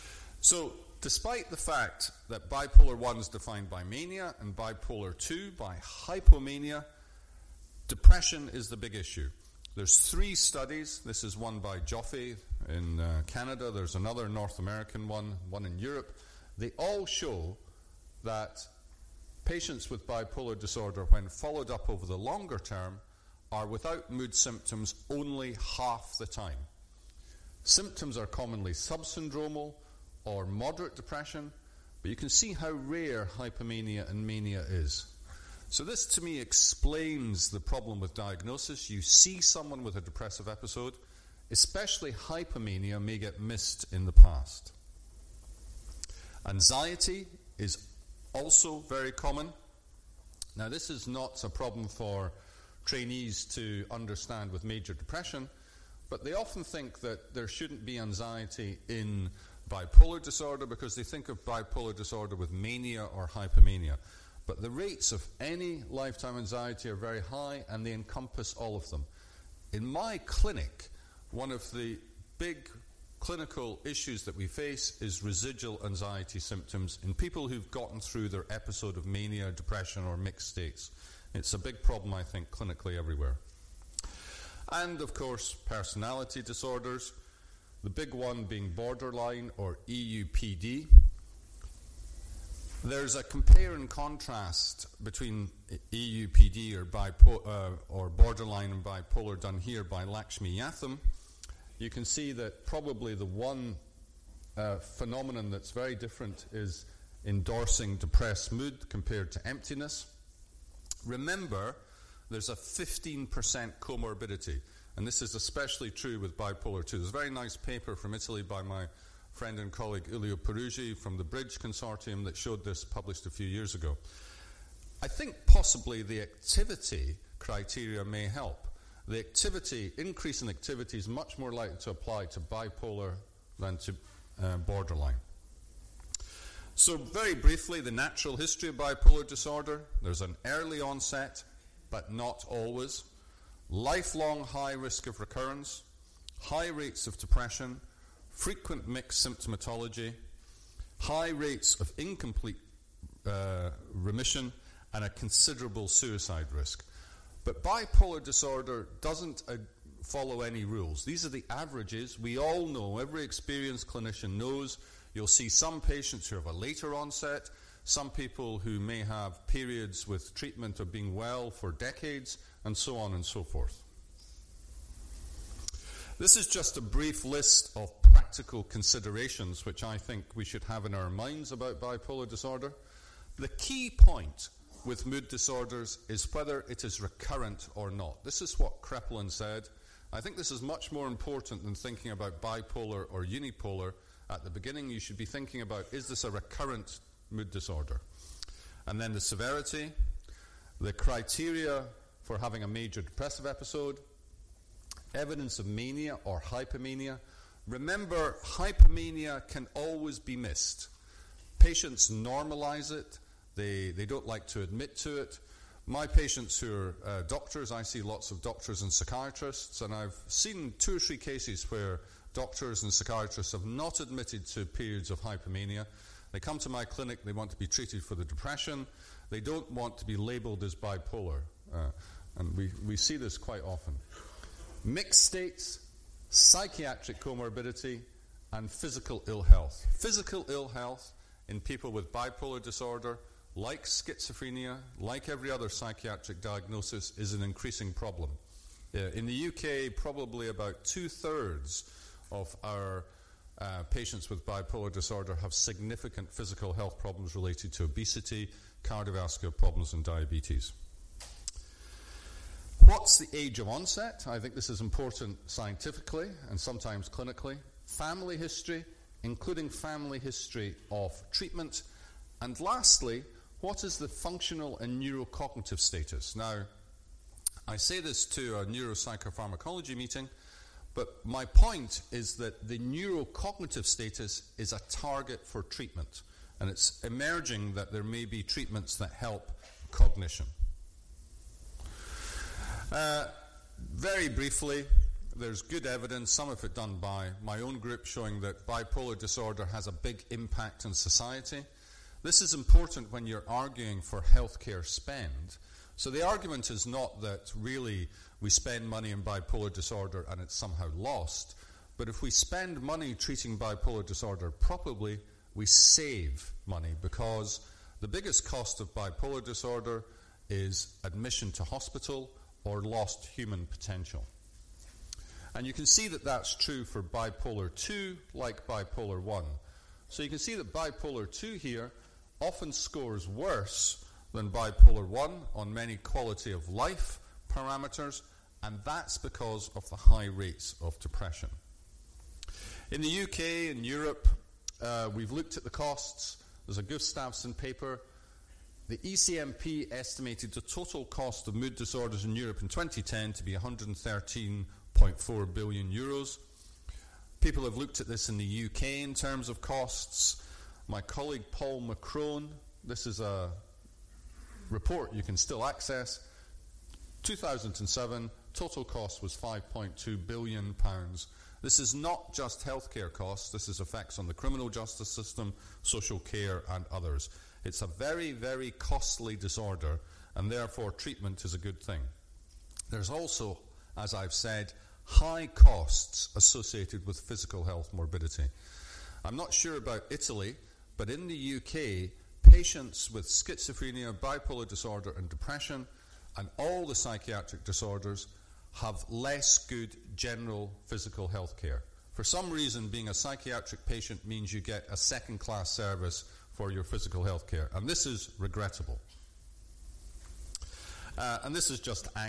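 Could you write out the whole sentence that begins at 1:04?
But the rates of any lifetime anxiety are very high and they encompass all of them.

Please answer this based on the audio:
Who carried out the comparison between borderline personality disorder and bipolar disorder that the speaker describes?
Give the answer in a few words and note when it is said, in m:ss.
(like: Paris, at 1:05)
Lakshmi Yatham, at 1:40.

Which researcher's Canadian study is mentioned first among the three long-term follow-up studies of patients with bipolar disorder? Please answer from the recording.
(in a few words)
Joffe.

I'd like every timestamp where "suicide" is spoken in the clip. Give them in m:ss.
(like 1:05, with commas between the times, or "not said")
2:35.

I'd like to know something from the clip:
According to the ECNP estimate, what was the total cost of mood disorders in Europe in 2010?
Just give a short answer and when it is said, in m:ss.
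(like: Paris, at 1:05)
113.4 billion euros, at 5:53.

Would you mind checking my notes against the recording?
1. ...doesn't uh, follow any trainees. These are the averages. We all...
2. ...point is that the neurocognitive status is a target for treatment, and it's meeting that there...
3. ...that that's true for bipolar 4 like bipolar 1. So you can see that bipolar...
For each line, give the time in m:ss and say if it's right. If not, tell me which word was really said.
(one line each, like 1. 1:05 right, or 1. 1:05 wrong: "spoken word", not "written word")
1. 2:39 wrong: "rules", not "trainees"
2. 4:41 wrong: "emerging", not "meeting"
3. 5:26 wrong: "2", not "4".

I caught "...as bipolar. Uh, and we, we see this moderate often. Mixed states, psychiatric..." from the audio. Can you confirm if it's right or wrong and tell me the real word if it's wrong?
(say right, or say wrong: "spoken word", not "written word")
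wrong: "quite", not "moderate".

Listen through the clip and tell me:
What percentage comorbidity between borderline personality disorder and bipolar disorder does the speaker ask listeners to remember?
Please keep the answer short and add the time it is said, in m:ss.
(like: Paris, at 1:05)
15%, at 1:52.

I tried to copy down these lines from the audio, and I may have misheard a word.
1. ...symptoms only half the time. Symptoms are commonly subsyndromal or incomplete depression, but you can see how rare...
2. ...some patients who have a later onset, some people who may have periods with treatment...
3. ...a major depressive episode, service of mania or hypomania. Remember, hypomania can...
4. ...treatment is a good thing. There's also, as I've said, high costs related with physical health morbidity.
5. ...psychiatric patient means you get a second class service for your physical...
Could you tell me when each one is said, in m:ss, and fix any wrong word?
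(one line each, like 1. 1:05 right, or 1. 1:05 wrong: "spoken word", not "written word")
1. 0:24 wrong: "moderate", not "incomplete"
2. 2:45 right
3. 3:22 wrong: "evidence", not "service"
4. 6:20 wrong: "associated", not "related"
5. 6:43 right.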